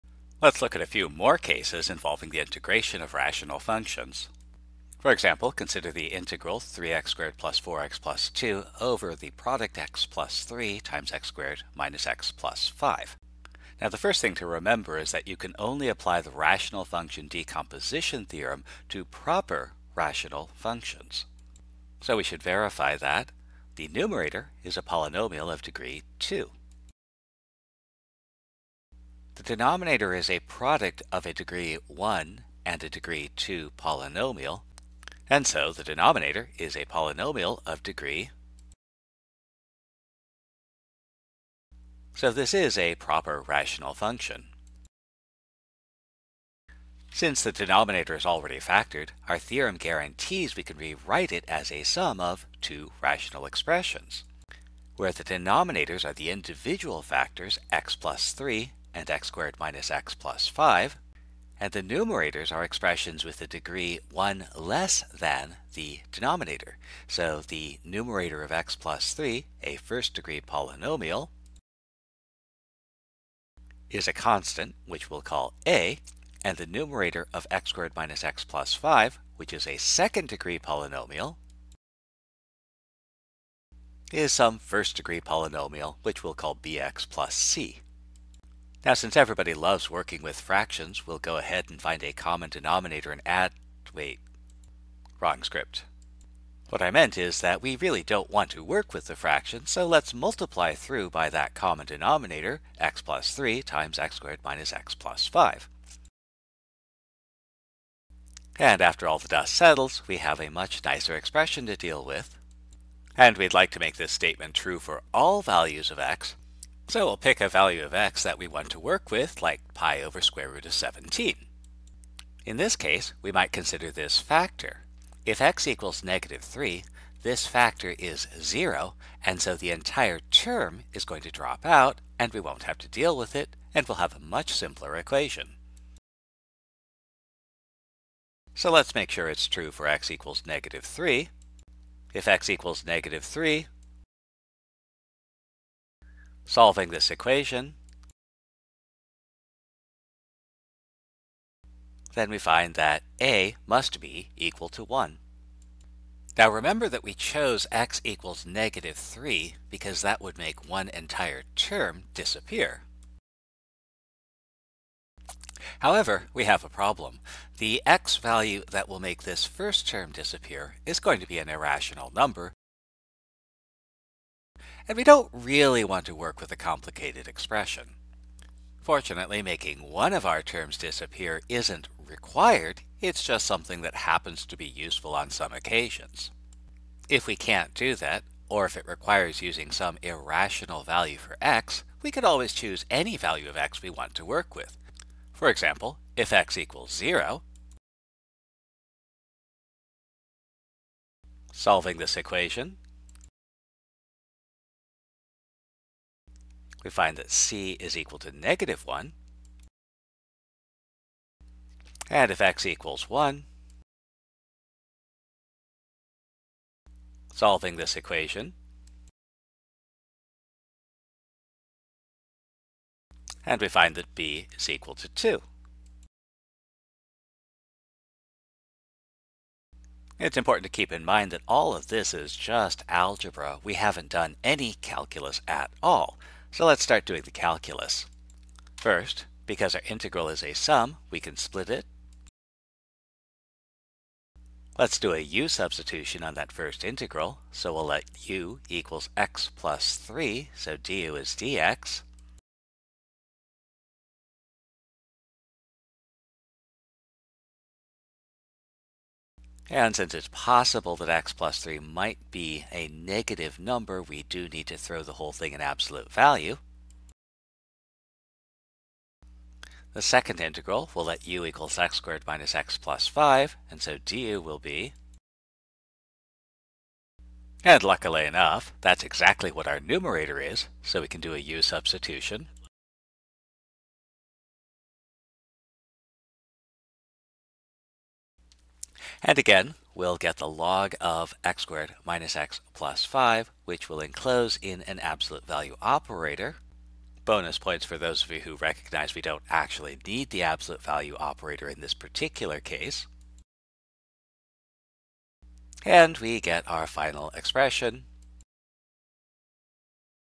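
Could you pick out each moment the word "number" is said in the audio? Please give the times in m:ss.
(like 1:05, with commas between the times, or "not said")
2:52, 4:23.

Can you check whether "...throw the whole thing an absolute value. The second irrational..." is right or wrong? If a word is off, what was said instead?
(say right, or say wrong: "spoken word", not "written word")
wrong: "integral", not "irrational".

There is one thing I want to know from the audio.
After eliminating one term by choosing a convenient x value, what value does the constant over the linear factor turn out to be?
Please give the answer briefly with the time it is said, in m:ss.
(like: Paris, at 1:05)
1, at 2:33.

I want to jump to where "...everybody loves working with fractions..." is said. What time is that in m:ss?
1:29.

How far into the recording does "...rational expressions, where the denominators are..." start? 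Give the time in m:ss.
0:53.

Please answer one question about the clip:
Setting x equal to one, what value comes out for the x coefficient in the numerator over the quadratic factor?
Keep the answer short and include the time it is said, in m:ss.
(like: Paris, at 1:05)
2, at 3:44.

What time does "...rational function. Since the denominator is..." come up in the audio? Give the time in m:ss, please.
0:43.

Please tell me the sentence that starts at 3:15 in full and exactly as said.
For example, if x equals 0, solving this equation, we find that c is equal to negative 1.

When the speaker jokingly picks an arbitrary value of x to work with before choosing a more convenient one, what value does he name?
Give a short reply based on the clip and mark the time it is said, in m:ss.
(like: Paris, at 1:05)
pi over square root of 17, at 1:59.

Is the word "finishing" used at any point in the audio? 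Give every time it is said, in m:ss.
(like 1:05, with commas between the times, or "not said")
not said.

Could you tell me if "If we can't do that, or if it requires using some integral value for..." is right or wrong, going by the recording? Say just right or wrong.
wrong.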